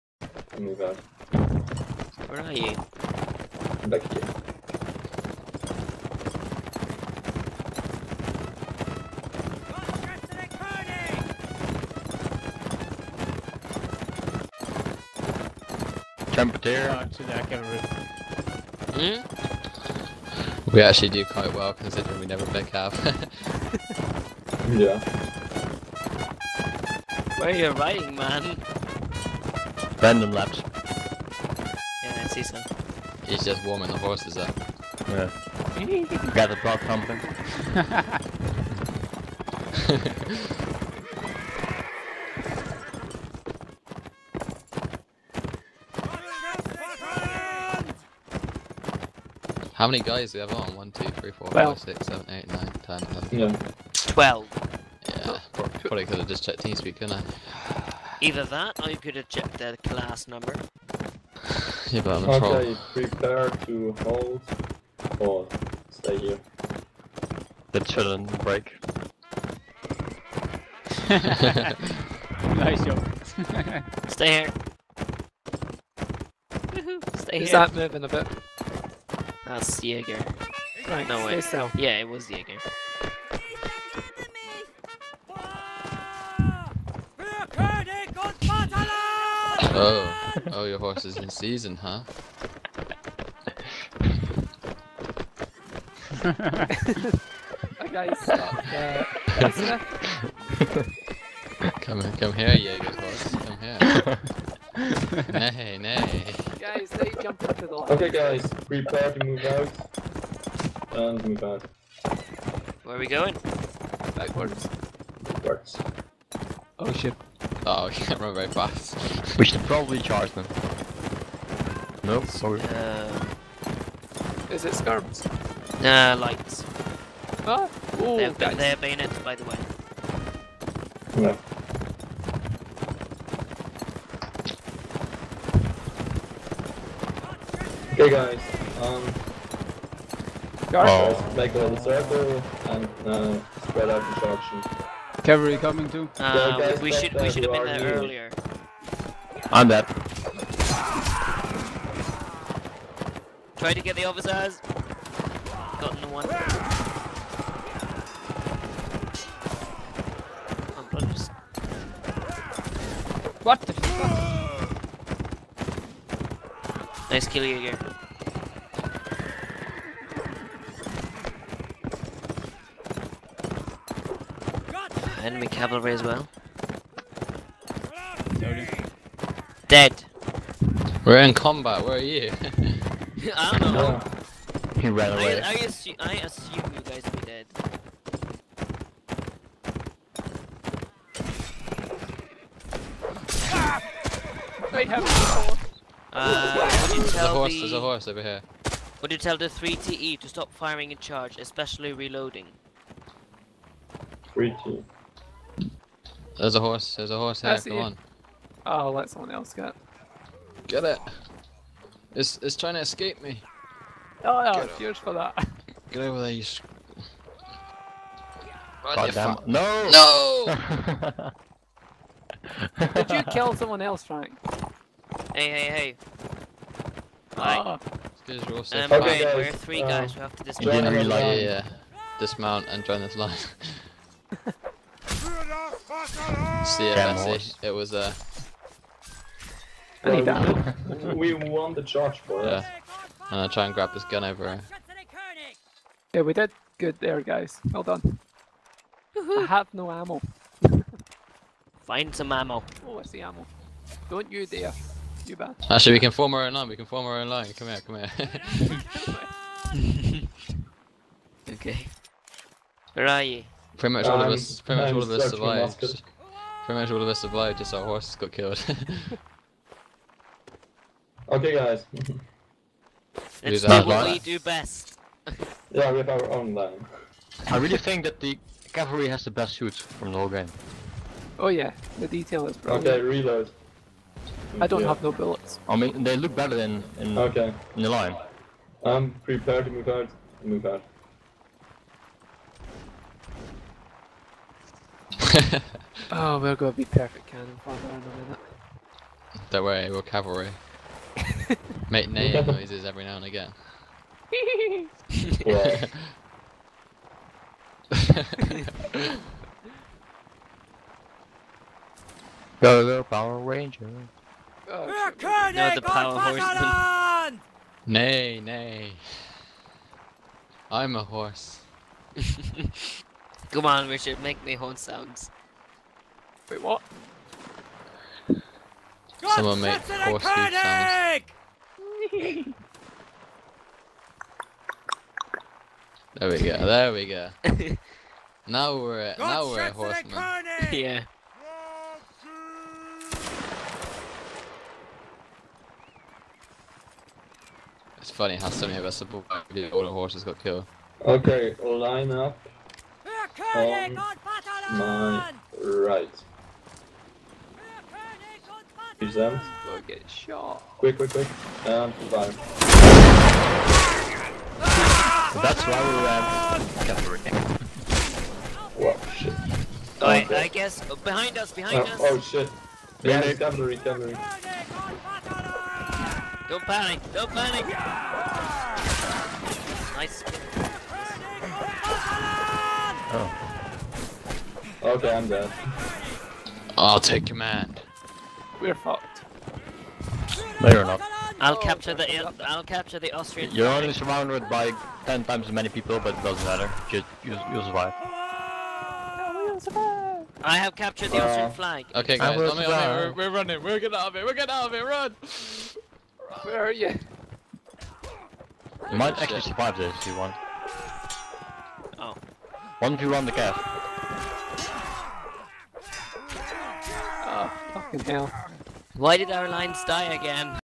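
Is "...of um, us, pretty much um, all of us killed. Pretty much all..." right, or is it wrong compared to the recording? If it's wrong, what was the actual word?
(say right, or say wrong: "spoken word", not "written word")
wrong: "survived", not "killed".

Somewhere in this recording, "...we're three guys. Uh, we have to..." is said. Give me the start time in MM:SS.
03:49.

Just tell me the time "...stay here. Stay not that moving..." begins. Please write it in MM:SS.
01:14.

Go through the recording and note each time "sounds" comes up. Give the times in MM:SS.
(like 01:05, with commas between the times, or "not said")
05:24, 05:30.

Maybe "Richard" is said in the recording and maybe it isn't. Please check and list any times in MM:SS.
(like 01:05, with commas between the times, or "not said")
05:23.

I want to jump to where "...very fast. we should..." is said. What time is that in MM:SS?
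01:58.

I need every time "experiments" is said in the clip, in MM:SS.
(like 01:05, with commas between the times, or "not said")
not said.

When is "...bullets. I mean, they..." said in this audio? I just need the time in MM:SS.
04:45.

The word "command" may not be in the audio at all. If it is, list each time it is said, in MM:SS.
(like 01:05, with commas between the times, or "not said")
06:27.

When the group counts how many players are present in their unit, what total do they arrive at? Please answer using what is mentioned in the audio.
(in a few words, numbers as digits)
12.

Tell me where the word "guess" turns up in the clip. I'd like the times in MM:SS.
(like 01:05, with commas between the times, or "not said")
06:10.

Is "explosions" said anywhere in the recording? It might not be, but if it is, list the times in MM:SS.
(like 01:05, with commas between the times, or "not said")
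not said.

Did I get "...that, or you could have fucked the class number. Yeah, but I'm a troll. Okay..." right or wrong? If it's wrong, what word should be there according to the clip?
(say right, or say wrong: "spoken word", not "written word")
wrong: "checked", not "fucked".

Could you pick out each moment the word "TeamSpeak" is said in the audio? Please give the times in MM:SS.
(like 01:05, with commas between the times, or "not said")
00:56.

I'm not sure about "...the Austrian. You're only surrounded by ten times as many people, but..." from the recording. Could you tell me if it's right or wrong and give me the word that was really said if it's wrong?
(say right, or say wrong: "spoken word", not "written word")
right.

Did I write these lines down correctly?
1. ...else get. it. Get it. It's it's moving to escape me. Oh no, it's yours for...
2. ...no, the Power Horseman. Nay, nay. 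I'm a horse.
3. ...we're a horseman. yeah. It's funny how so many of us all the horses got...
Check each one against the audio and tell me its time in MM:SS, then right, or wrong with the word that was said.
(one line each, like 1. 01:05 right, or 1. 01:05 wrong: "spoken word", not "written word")
1. 03:29 wrong: "trying", not "moving"
2. 05:15 right
3. 05:39 right.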